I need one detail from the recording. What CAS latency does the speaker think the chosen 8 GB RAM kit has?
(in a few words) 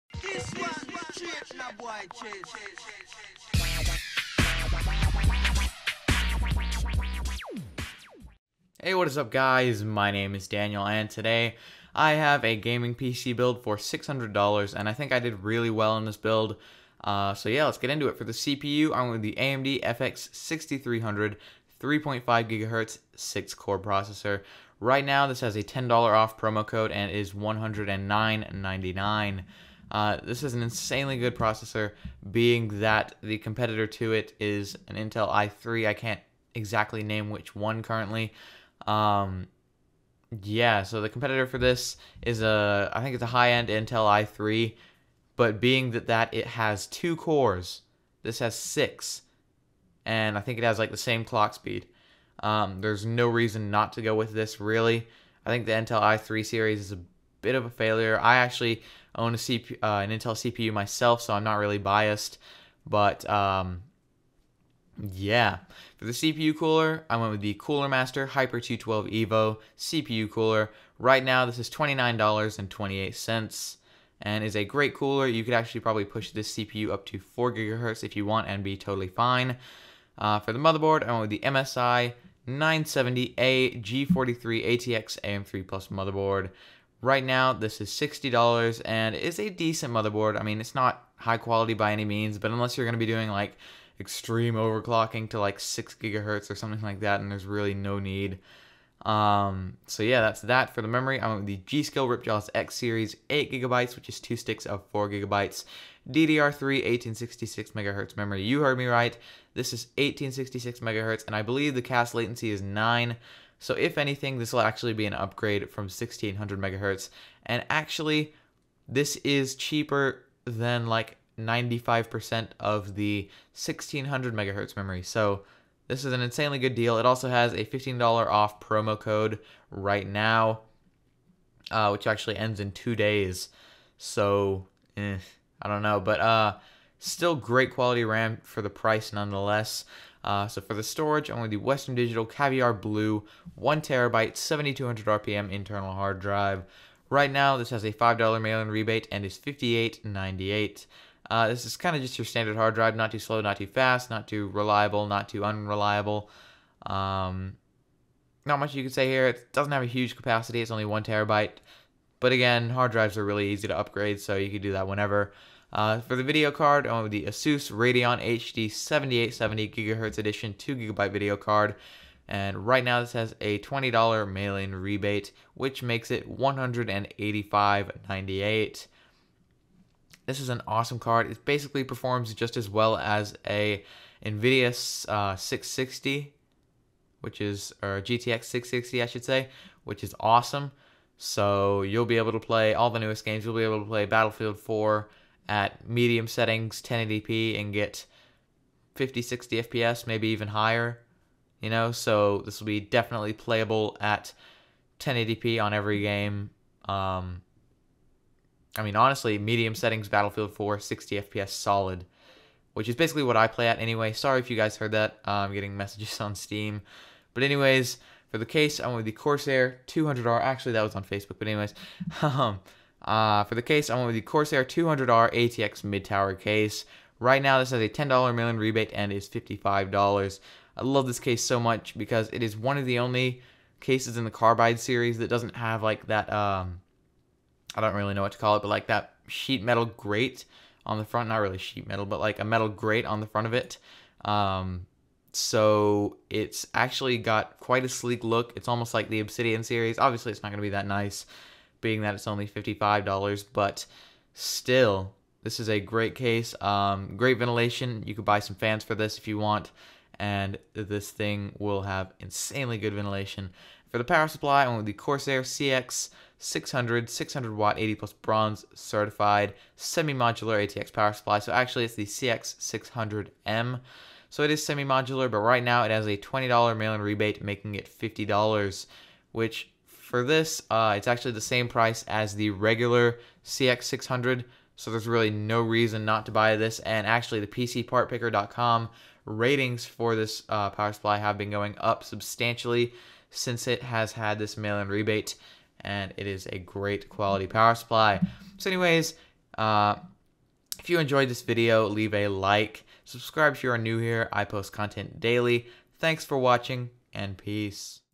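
9.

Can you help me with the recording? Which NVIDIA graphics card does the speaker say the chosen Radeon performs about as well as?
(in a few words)
GTX 660.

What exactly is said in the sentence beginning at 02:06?
It also has a $15 off promo code right now, uh, which actually ends in two days.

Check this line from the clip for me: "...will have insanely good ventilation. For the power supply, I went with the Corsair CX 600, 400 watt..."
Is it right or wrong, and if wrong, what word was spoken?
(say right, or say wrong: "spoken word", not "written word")
wrong: "600", not "400".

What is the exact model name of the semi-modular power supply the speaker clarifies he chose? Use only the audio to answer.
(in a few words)
CX 600M.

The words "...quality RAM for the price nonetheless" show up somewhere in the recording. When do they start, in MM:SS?
02:17.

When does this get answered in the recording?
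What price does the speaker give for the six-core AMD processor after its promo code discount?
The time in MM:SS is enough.
00:27.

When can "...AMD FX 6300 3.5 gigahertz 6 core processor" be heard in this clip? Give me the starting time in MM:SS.
00:19.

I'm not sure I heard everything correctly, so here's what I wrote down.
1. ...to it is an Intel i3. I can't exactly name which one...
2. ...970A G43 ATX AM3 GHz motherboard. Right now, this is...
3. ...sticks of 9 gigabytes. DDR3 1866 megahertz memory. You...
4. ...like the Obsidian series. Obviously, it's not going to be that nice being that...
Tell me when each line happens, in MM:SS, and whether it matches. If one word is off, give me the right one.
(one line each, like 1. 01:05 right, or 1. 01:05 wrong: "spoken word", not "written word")
1. 00:33 right
2. 01:22 wrong: "Plus", not "GHz"
3. 01:44 wrong: "4", not "9"
4. 04:08 right.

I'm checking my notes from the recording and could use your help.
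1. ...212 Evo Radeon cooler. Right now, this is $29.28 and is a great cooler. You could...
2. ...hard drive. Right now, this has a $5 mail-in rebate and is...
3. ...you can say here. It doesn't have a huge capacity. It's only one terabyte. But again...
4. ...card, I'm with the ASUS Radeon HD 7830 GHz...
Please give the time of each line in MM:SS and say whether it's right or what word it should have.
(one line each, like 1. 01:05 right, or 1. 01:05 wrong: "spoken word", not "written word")
1. 01:08 wrong: "CPU", not "Radeon"
2. 02:25 right
3. 02:38 right
4. 02:46 wrong: "7870", not "7830".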